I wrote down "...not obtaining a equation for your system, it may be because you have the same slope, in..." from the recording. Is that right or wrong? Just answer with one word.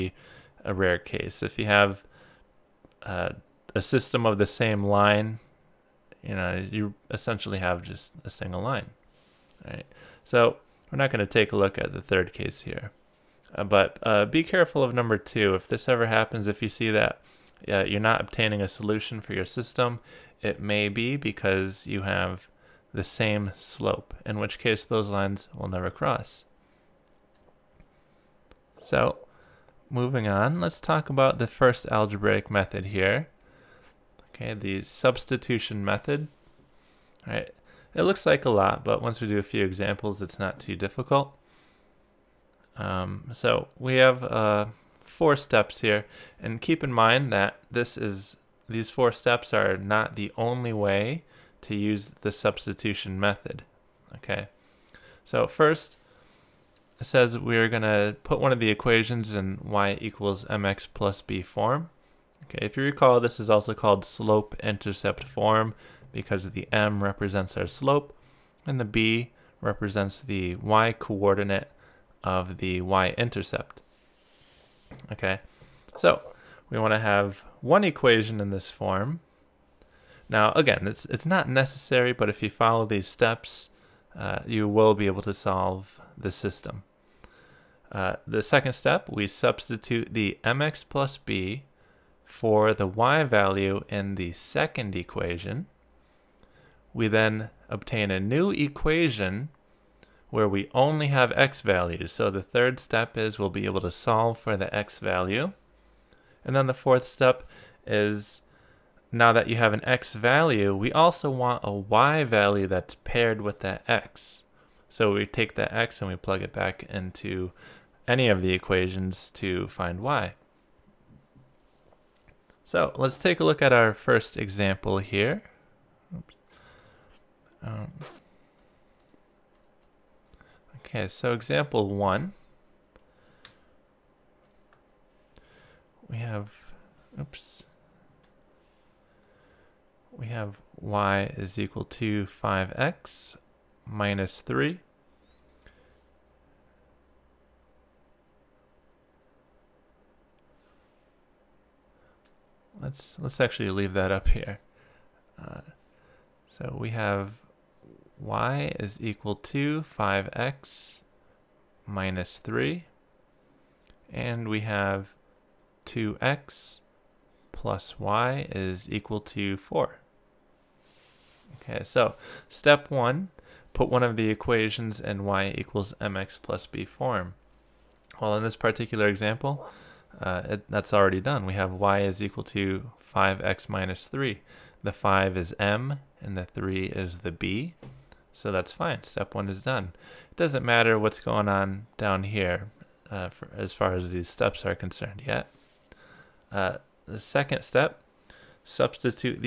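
wrong.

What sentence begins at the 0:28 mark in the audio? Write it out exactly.
So moving on, let's talk about the first algebraic method here.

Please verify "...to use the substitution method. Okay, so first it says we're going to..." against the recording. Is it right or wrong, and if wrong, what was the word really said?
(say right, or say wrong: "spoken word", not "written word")
right.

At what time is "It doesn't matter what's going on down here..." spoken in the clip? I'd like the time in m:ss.
3:10.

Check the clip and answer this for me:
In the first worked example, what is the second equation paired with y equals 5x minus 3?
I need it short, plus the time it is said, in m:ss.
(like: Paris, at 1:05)
2x + y = 4, at 2:45.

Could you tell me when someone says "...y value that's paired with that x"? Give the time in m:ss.
1:51.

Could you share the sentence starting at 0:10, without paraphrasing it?
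So we're not going to take a look at the third case here.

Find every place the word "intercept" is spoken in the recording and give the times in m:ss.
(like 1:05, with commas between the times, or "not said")
1:04, 1:12.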